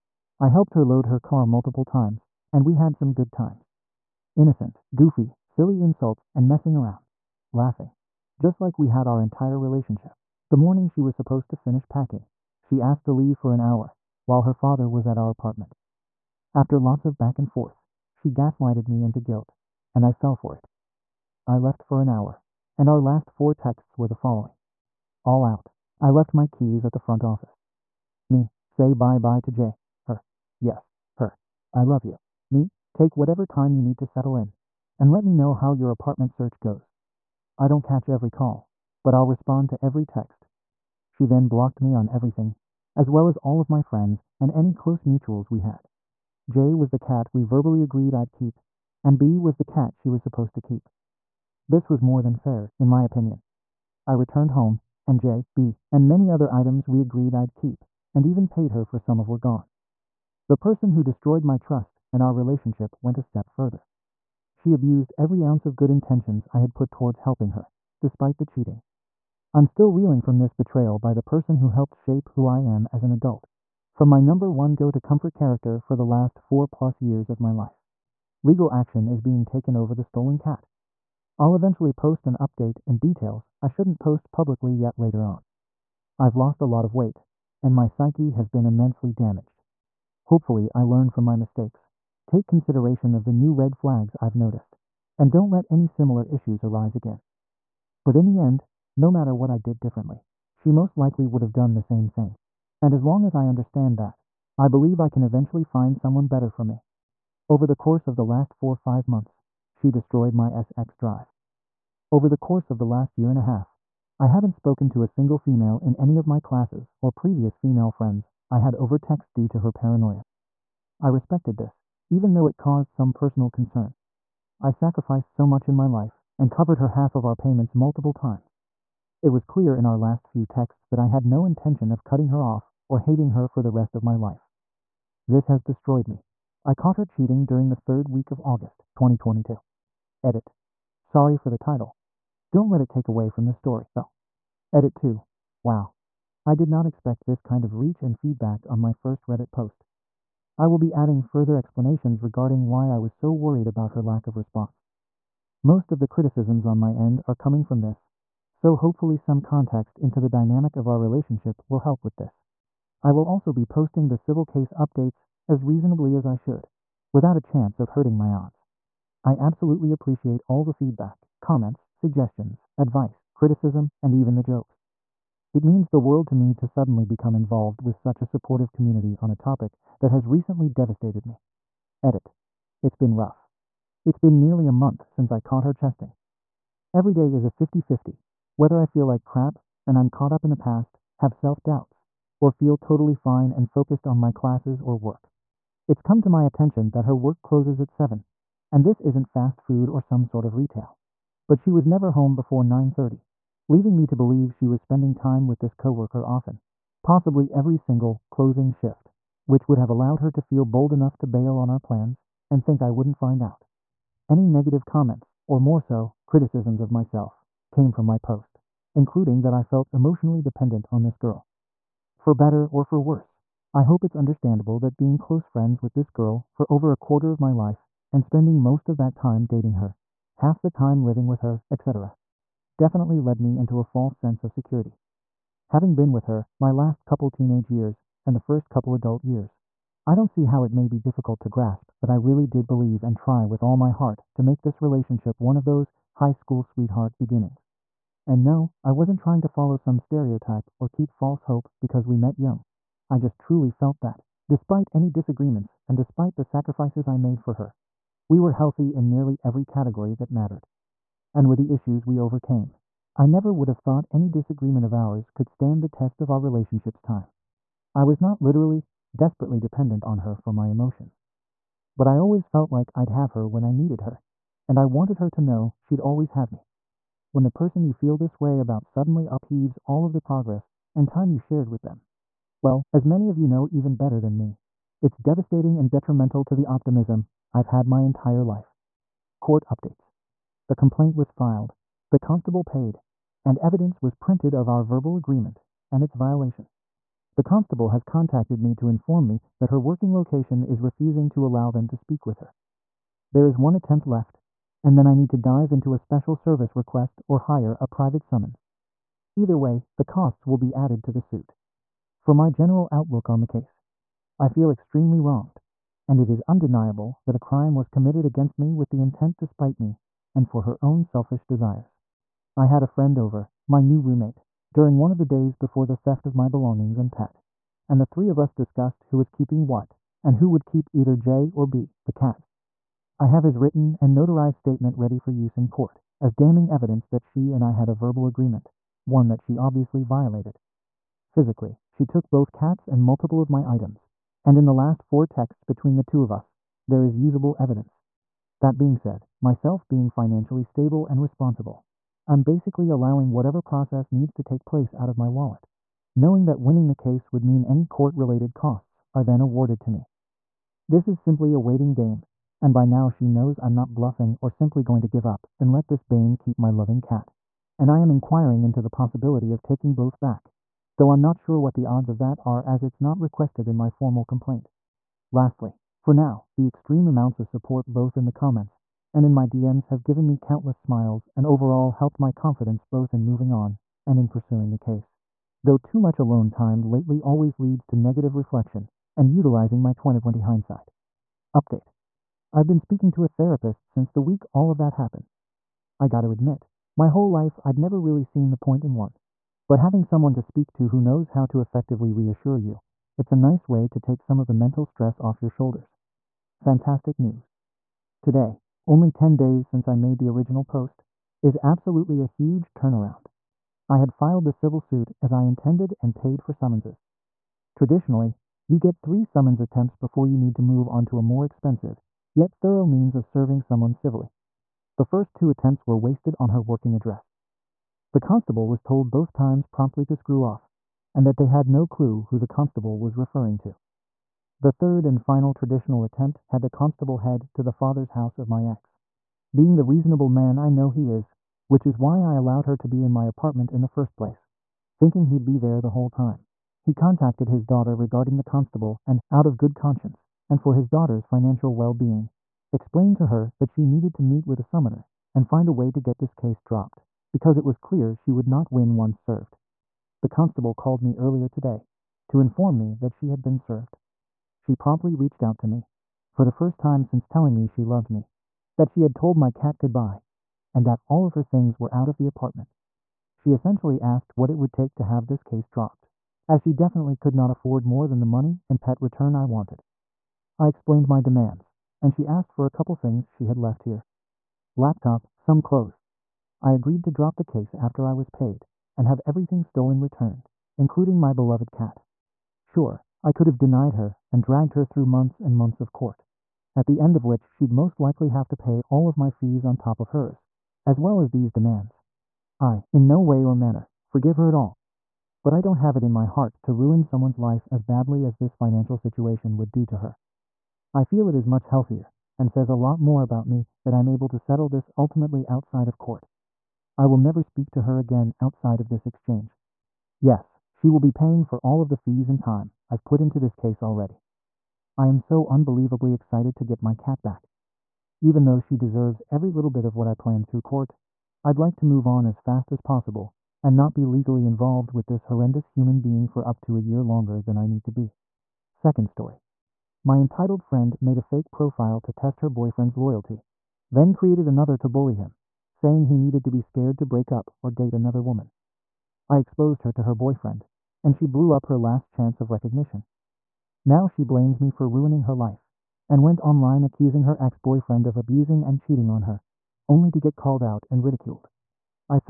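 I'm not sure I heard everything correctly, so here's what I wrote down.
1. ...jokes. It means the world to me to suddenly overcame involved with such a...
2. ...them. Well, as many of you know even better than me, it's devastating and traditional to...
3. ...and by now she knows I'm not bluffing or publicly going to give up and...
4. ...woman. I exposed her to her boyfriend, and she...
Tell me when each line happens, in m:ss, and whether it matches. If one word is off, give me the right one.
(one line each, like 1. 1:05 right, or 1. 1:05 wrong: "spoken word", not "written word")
1. 2:54 wrong: "become", not "overcame"
2. 4:41 wrong: "detrimental", not "traditional"
3. 6:02 wrong: "simply", not "publicly"
4. 9:08 right.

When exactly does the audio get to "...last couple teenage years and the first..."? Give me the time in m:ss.
3:56.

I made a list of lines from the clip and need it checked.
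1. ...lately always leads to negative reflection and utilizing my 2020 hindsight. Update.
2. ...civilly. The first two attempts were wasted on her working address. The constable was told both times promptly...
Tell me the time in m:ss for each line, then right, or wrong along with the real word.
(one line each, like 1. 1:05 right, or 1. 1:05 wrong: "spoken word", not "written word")
1. 6:26 right
2. 7:03 right.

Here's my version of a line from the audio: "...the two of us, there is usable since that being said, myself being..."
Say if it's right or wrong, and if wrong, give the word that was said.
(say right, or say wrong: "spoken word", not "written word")
wrong: "evidence", not "since".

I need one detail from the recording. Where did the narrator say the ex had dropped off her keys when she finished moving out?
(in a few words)
front office.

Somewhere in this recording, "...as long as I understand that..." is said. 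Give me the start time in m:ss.
1:42.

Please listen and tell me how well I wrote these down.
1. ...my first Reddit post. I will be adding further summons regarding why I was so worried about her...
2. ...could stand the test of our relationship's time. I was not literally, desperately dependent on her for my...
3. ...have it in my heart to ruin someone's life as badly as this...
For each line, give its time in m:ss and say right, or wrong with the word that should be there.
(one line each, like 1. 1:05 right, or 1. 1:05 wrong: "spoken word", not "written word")
1. 2:28 wrong: "explanations", not "summons"
2. 4:25 right
3. 8:25 right.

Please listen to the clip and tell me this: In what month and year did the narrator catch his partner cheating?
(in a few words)
August 2022.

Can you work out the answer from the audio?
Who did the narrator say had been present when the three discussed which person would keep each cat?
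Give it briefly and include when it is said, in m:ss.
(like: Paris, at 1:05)
new roommate, at 5:23.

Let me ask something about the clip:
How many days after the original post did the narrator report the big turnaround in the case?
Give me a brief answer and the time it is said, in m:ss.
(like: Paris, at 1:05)
10, at 6:49.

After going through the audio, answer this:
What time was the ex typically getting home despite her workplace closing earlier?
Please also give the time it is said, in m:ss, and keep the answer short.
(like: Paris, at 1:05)
9:30, at 3:22.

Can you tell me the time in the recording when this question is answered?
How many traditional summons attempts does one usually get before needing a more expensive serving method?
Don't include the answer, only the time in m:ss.
6:58.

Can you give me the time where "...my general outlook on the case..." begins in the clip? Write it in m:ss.
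5:12.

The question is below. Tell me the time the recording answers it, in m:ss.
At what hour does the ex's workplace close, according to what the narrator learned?
3:17.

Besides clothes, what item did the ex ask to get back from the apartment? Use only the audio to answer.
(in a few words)
Laptop.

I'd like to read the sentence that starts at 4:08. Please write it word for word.
And no, I wasn't trying to follow some stereotype or keep false hope because we met young.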